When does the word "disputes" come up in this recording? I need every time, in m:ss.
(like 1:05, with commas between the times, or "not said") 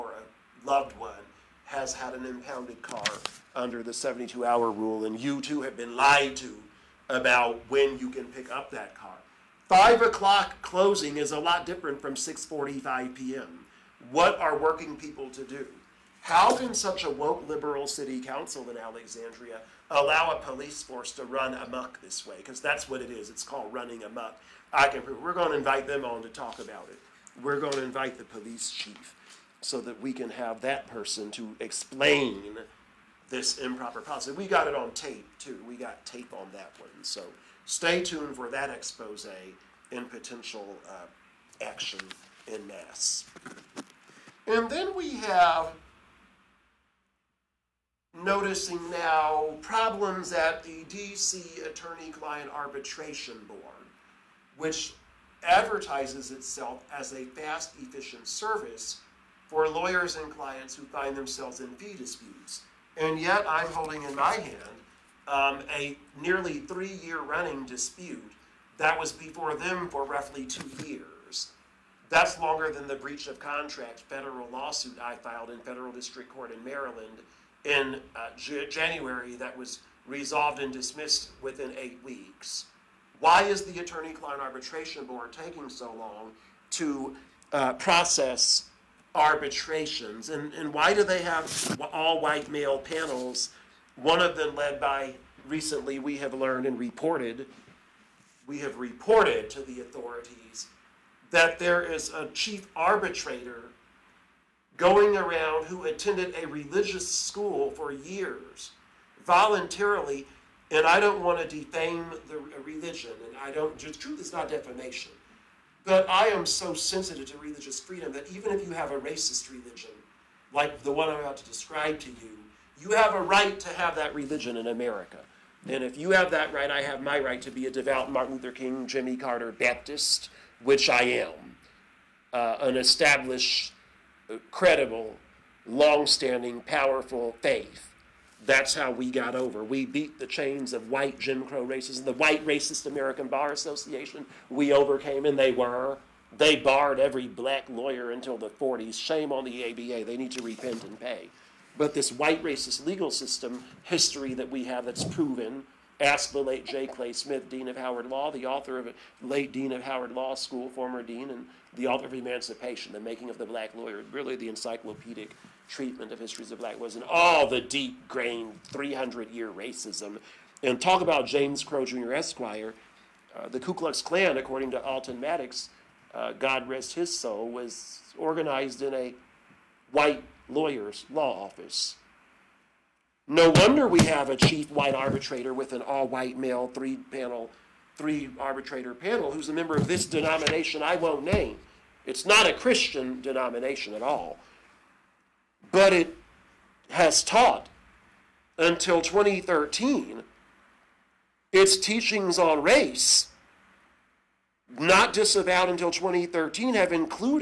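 1:01, 1:07.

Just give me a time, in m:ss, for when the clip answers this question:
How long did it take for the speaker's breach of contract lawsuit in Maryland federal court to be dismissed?
1:21.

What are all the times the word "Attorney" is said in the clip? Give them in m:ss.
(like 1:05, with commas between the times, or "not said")
0:51, 1:23.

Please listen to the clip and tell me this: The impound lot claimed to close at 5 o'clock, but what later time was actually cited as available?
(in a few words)
6:45 p.m.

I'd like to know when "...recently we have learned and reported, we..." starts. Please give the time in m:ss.
1:35.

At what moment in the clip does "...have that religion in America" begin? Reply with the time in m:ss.
2:03.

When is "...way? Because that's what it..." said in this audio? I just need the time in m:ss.
0:22.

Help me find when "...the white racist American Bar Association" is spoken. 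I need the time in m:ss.
2:22.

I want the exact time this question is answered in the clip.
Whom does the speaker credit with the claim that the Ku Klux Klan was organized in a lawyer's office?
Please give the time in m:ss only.
2:54.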